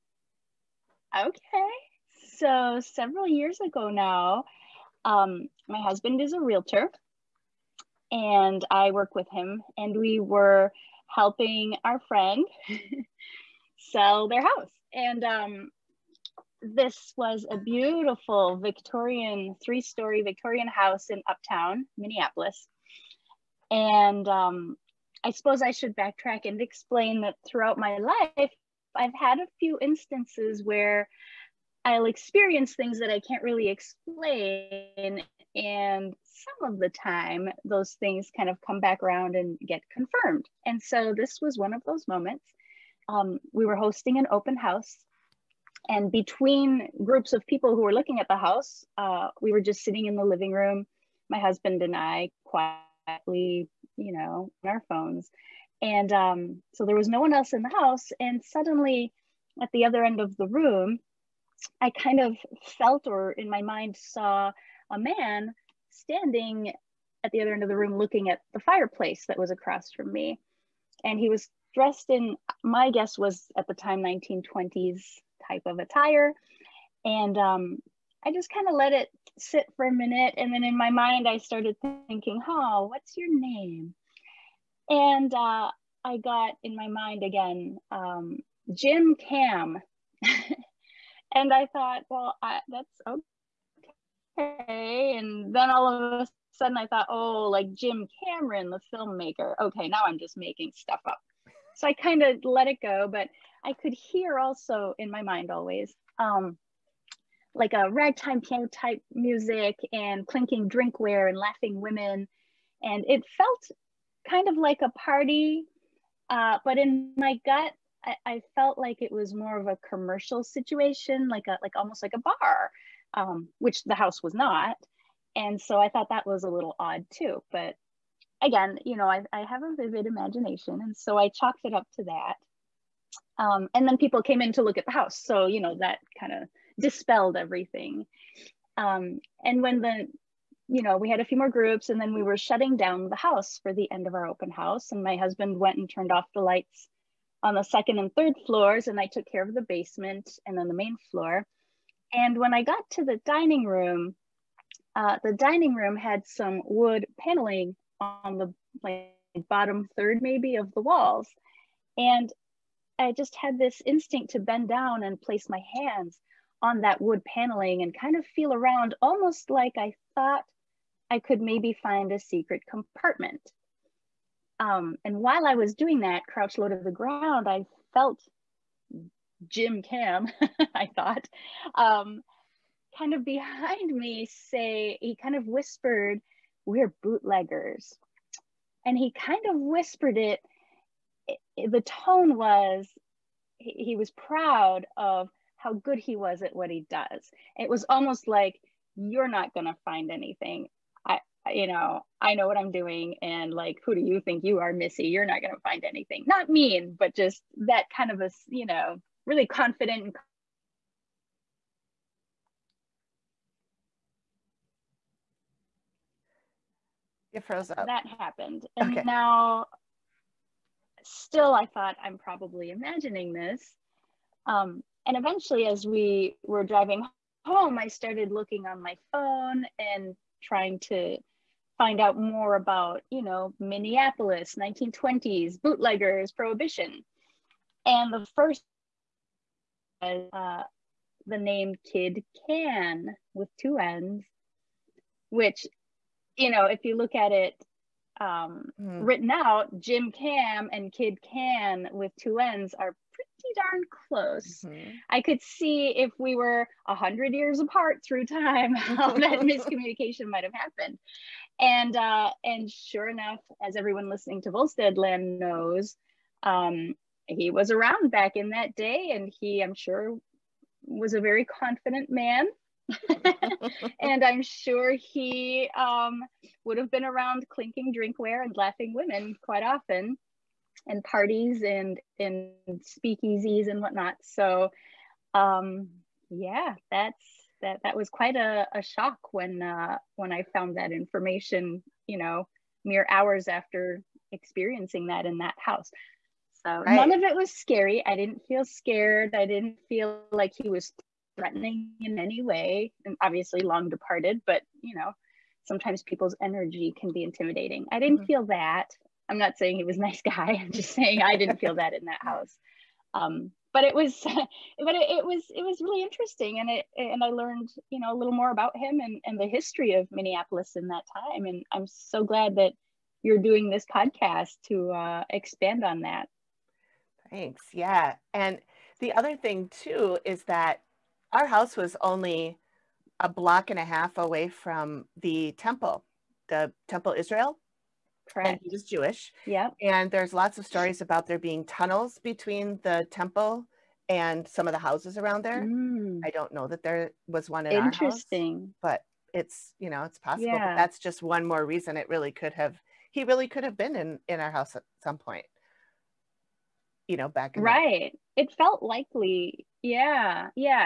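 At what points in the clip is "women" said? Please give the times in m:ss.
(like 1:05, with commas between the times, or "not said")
1:51, 4:38.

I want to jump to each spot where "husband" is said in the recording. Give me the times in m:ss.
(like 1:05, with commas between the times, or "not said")
0:05, 0:51, 2:25.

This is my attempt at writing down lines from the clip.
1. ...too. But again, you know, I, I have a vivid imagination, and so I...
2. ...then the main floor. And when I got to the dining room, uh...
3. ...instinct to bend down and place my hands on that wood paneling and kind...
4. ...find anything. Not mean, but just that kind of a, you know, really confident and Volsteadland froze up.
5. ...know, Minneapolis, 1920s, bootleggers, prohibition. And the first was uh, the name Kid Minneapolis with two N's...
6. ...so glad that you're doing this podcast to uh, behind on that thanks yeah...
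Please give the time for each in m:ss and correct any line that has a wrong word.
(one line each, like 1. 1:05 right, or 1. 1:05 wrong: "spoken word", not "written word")
1. 2:07 right
2. 2:30 right
3. 2:43 right
4. 3:25 wrong: "You", not "Volsteadland"
5. 3:53 wrong: "Cann", not "Minneapolis"
6. 5:21 wrong: "expand", not "behind".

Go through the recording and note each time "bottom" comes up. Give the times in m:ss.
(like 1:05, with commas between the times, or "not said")
2:39.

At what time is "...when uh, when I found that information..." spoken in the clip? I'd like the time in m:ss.
4:49.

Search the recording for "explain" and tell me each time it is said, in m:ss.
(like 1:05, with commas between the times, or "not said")
0:26, 0:33.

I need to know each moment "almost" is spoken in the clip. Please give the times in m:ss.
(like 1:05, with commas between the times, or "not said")
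2:01, 2:49, 3:17.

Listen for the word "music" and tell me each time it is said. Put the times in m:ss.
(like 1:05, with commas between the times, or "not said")
1:49.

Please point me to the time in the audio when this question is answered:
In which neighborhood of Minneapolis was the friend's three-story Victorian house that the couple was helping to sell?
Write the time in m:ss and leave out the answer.
0:21.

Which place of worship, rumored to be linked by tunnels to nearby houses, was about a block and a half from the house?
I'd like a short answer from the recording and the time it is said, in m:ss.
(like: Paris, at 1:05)
Temple Israel, at 5:36.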